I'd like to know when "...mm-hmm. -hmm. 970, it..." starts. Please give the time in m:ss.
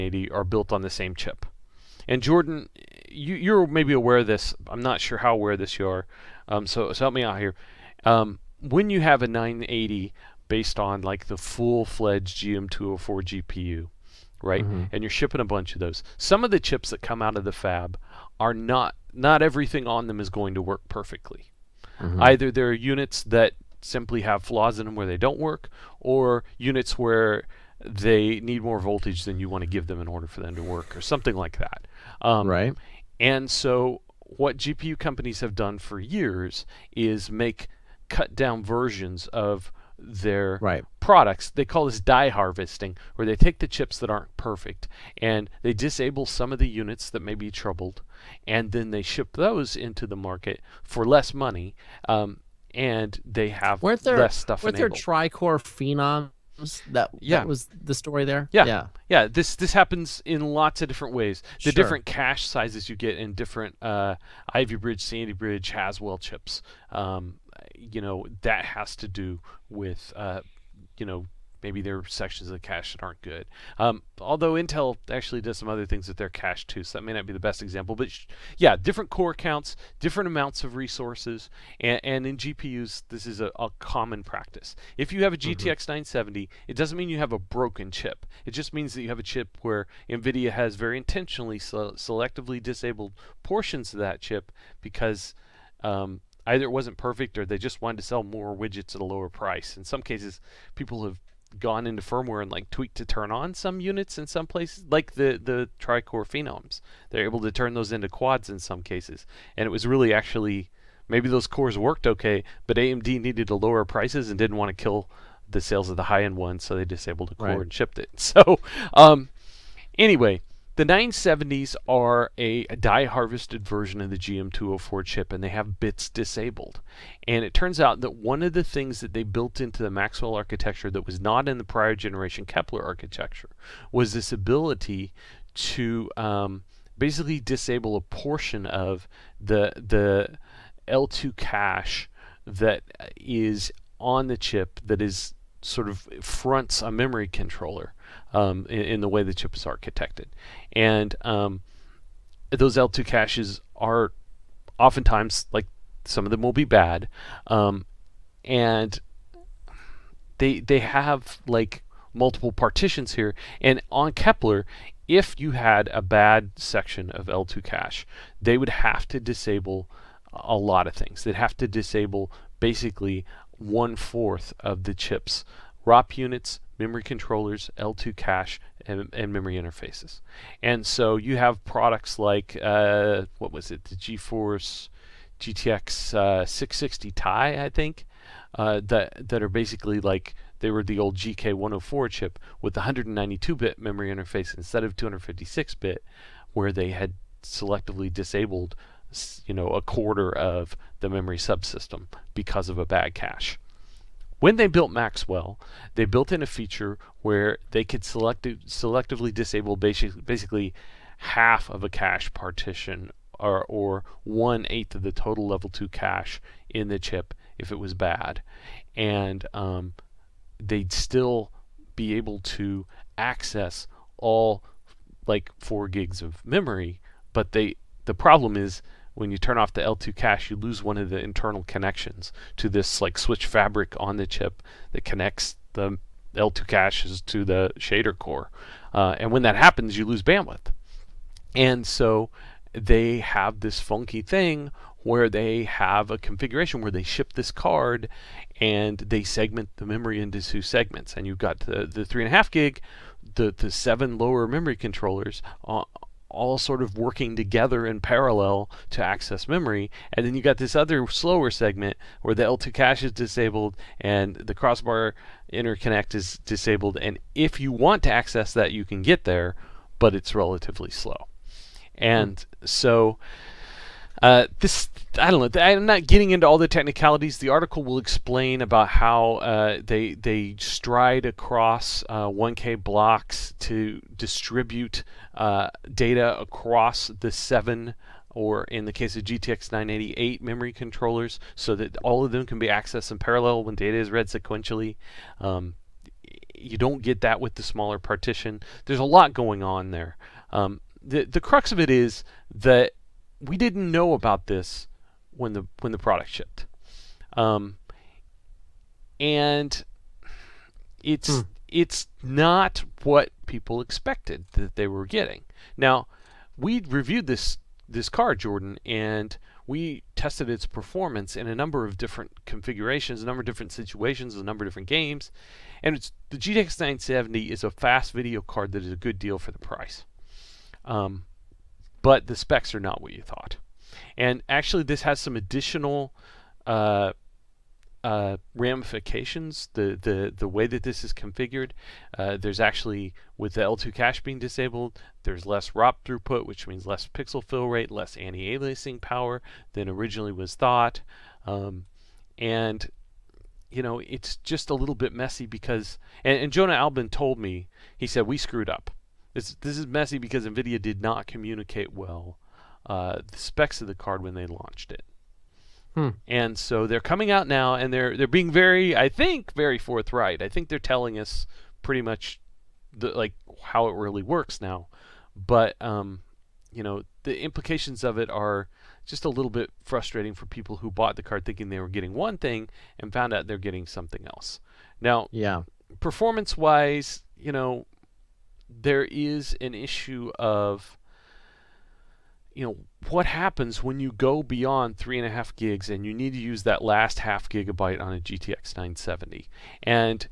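1:25.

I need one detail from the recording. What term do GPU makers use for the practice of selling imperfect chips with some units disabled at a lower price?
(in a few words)
die harvesting.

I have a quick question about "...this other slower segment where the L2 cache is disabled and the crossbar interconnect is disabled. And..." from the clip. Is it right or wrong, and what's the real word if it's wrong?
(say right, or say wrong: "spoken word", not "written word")
right.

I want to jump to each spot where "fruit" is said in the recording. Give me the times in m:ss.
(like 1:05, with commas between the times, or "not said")
not said.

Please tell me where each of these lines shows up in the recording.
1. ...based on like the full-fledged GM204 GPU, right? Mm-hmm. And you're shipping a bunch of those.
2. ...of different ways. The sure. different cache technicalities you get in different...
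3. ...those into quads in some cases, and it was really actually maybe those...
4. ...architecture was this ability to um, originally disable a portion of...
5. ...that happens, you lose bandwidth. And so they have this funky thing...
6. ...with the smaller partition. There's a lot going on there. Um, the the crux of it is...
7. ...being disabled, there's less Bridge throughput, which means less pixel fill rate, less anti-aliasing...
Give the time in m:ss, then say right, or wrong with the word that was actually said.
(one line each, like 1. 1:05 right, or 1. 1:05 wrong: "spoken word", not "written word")
1. 0:10 right
2. 1:00 wrong: "sizes", not "technicalities"
3. 1:47 right
4. 2:12 wrong: "basically", not "originally"
5. 3:59 right
6. 4:57 right
7. 5:44 wrong: "ROP", not "Bridge".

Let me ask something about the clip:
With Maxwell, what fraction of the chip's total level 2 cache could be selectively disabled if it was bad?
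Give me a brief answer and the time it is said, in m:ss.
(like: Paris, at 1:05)
one eighth, at 3:34.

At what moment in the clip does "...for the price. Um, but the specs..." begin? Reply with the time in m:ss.
5:29.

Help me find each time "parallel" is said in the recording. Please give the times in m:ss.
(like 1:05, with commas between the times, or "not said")
4:18, 4:53.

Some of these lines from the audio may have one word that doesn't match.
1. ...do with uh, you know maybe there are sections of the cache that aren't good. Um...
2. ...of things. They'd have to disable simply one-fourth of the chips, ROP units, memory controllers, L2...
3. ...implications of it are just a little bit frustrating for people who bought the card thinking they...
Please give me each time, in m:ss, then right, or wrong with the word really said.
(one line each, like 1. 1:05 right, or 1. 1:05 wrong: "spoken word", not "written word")
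1. 1:09 right
2. 2:50 wrong: "basically", not "simply"
3. 6:17 right.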